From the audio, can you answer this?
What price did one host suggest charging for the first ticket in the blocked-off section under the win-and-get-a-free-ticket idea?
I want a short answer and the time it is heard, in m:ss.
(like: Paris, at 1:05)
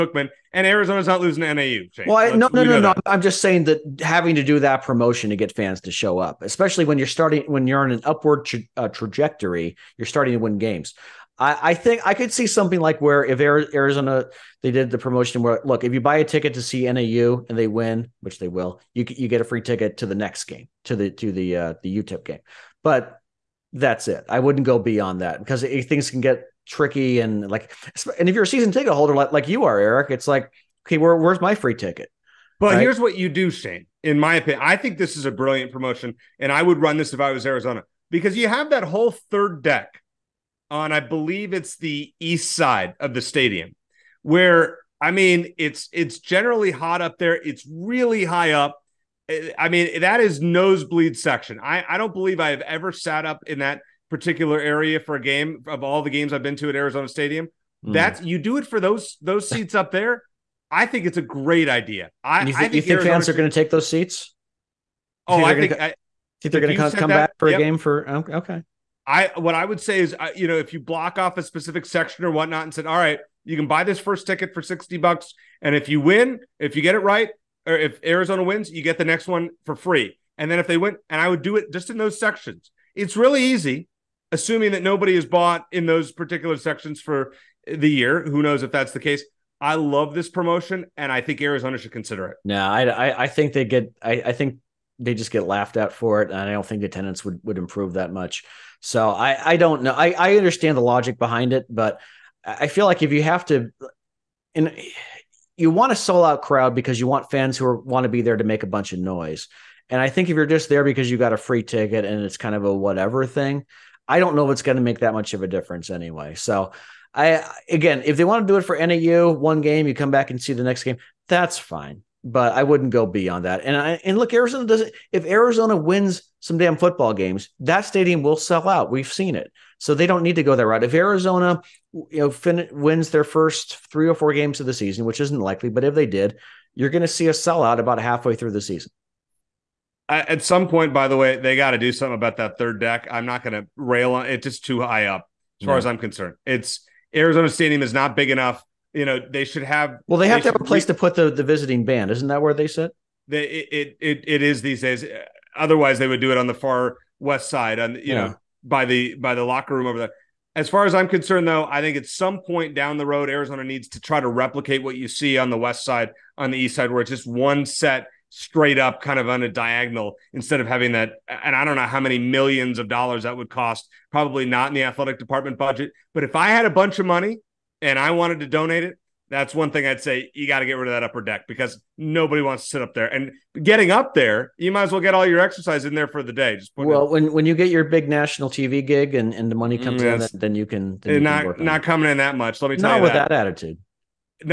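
$60, at 1:14.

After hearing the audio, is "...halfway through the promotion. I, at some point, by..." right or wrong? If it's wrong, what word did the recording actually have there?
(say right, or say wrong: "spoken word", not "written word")
wrong: "season", not "promotion".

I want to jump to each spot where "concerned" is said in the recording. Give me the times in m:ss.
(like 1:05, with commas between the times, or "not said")
2:25, 2:41.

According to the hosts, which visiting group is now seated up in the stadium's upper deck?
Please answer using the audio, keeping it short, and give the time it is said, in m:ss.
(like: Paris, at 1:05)
The visiting band, at 2:31.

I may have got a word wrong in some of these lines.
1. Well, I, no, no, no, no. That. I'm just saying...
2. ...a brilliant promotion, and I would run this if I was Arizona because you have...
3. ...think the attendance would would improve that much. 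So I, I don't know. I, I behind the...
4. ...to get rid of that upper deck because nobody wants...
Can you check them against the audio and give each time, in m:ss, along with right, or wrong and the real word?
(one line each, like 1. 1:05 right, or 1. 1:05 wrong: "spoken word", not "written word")
1. 0:02 right
2. 0:35 right
3. 1:36 wrong: "understand", not "behind"
4. 3:00 right.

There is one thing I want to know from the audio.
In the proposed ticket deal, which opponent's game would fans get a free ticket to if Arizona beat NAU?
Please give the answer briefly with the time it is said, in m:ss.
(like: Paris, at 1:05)
UTEP, at 0:22.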